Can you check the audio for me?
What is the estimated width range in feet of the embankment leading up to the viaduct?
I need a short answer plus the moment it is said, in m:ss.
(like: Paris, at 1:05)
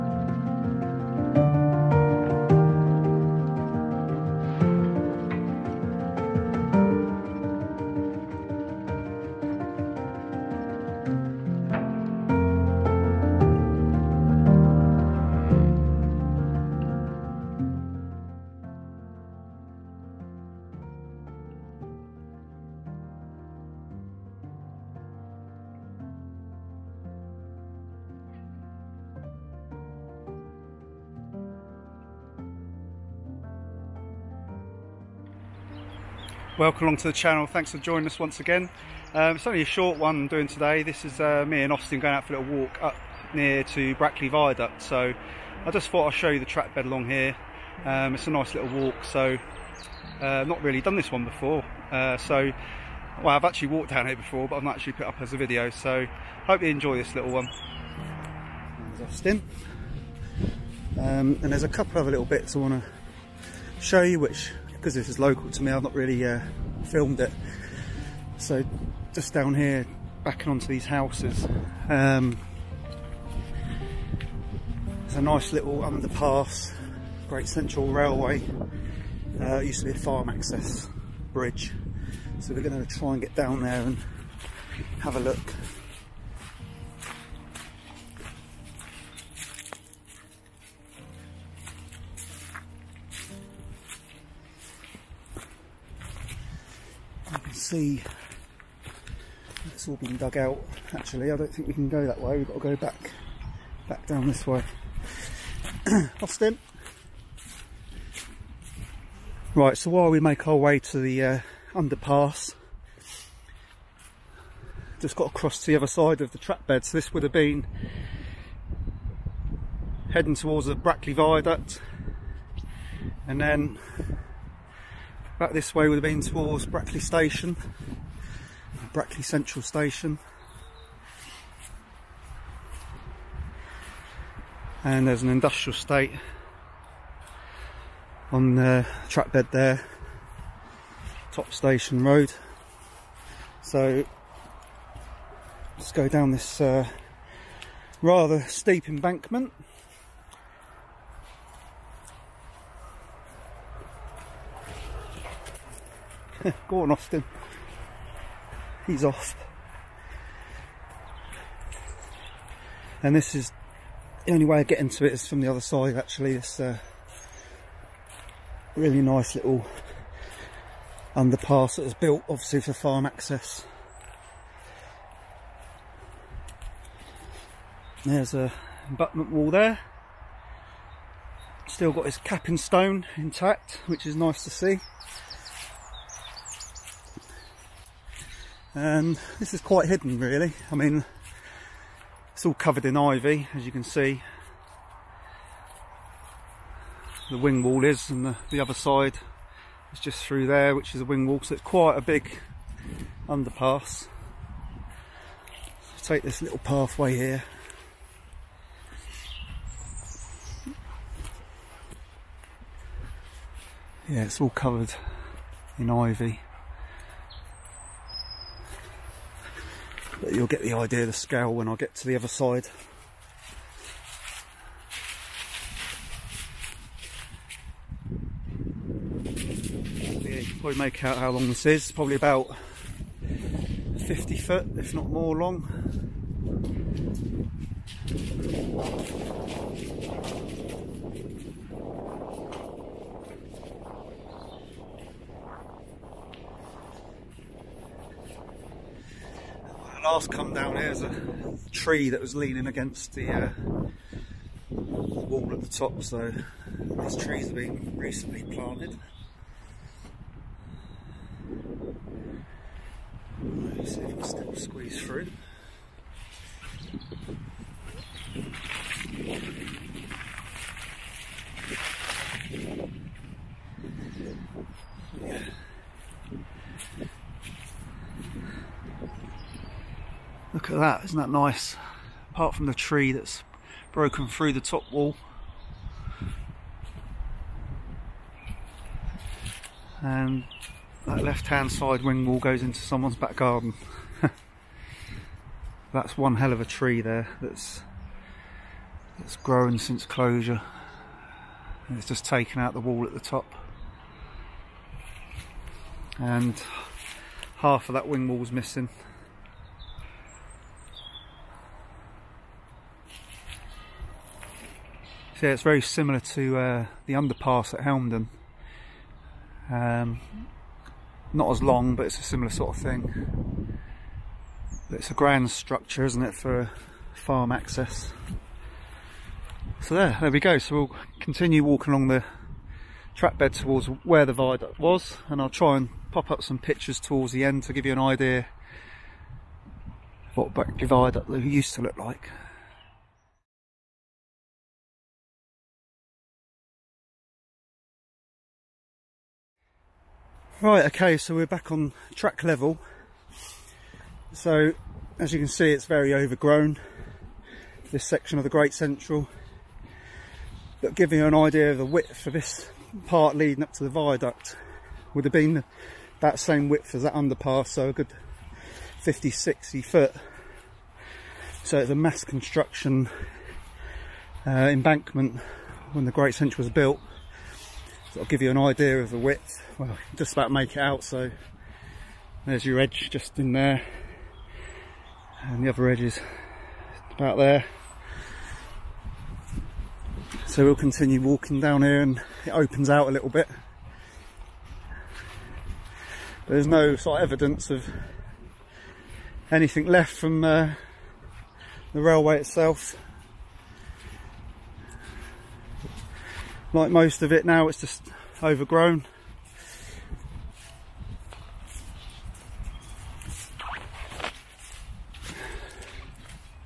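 50 to 60 feet, at 6:09.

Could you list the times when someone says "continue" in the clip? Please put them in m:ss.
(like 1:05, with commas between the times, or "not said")
5:31, 6:30.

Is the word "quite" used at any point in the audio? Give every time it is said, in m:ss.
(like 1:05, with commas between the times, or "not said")
3:09, 3:21.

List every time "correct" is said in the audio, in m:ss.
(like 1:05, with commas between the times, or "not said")
not said.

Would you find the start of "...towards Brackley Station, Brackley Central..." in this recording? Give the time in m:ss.
2:06.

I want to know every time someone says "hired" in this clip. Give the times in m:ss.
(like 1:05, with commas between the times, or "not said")
not said.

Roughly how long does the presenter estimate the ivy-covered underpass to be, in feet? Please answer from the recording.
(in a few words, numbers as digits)
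50 feet.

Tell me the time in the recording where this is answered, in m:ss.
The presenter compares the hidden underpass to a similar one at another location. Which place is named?
5:17.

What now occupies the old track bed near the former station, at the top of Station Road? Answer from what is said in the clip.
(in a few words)
An industrial estate.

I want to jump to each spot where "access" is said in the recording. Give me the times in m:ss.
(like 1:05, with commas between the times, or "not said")
1:20, 2:53, 5:27.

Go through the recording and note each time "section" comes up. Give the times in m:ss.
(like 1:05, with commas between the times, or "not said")
5:58.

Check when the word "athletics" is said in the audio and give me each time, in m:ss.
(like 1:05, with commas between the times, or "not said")
not said.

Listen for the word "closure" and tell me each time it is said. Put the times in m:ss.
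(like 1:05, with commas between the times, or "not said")
5:00.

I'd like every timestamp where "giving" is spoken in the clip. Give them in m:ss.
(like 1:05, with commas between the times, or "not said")
6:00.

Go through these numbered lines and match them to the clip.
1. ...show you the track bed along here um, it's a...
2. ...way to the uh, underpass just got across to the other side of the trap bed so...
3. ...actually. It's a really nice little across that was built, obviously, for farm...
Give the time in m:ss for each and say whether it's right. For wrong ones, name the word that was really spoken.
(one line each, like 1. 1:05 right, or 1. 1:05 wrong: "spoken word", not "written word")
1. 0:46 right
2. 1:50 right
3. 2:45 wrong: "underpass", not "across".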